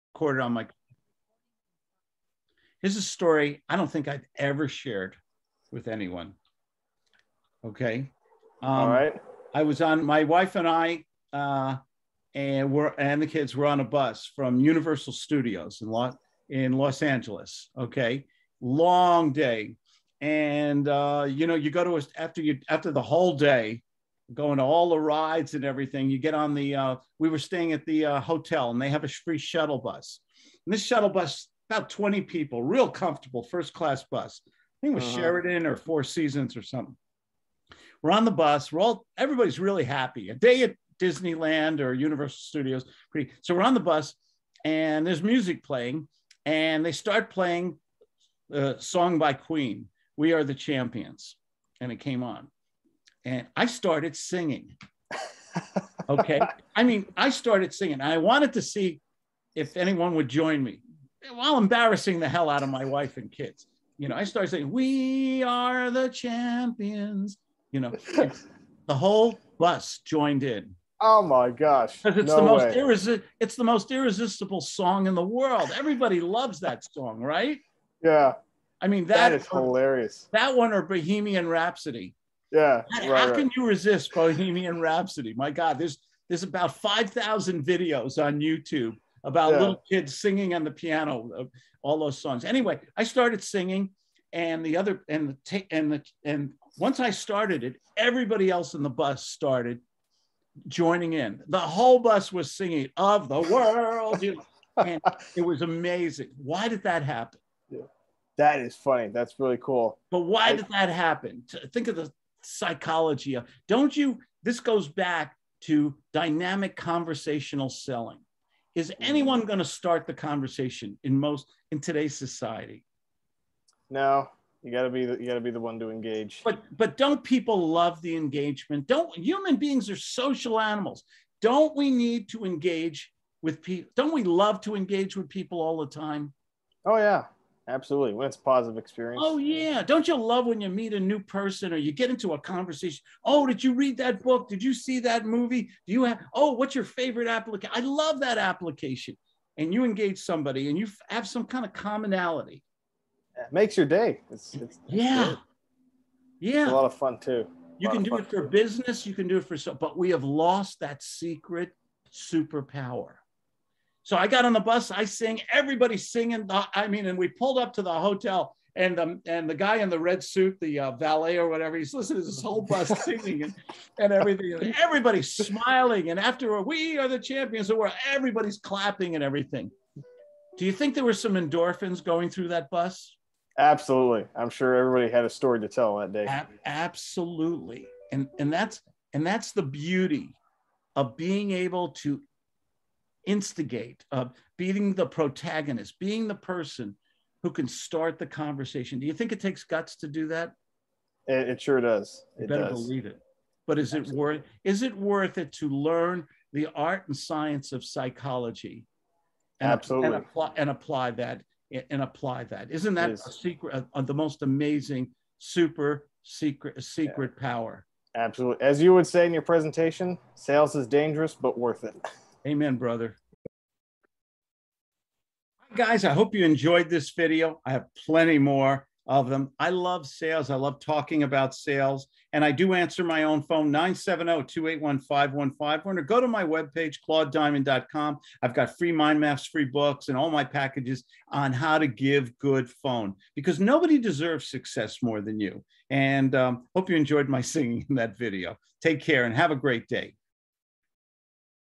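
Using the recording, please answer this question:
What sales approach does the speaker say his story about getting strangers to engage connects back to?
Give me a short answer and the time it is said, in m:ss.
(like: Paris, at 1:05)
Dynamic conversational selling, at 1:56.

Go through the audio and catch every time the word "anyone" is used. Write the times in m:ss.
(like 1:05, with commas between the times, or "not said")
0:05, 0:59, 1:59.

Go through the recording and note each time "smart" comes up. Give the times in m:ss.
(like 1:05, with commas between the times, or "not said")
not said.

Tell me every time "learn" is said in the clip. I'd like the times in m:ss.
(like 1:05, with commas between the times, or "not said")
3:25.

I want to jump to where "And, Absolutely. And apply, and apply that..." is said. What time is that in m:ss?
3:29.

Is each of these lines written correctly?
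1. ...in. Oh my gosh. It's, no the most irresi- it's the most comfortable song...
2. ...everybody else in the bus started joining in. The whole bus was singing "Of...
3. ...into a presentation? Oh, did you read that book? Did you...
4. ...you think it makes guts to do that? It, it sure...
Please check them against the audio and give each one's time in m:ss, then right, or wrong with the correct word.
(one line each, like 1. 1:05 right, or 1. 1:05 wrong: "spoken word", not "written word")
1. 1:10 wrong: "irresistible", not "comfortable"
2. 1:37 right
3. 2:22 wrong: "conversation", not "presentation"
4. 3:19 wrong: "takes", not "makes".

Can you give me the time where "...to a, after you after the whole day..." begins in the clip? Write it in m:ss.
0:21.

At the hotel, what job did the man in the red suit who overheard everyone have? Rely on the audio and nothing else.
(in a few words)
Valet.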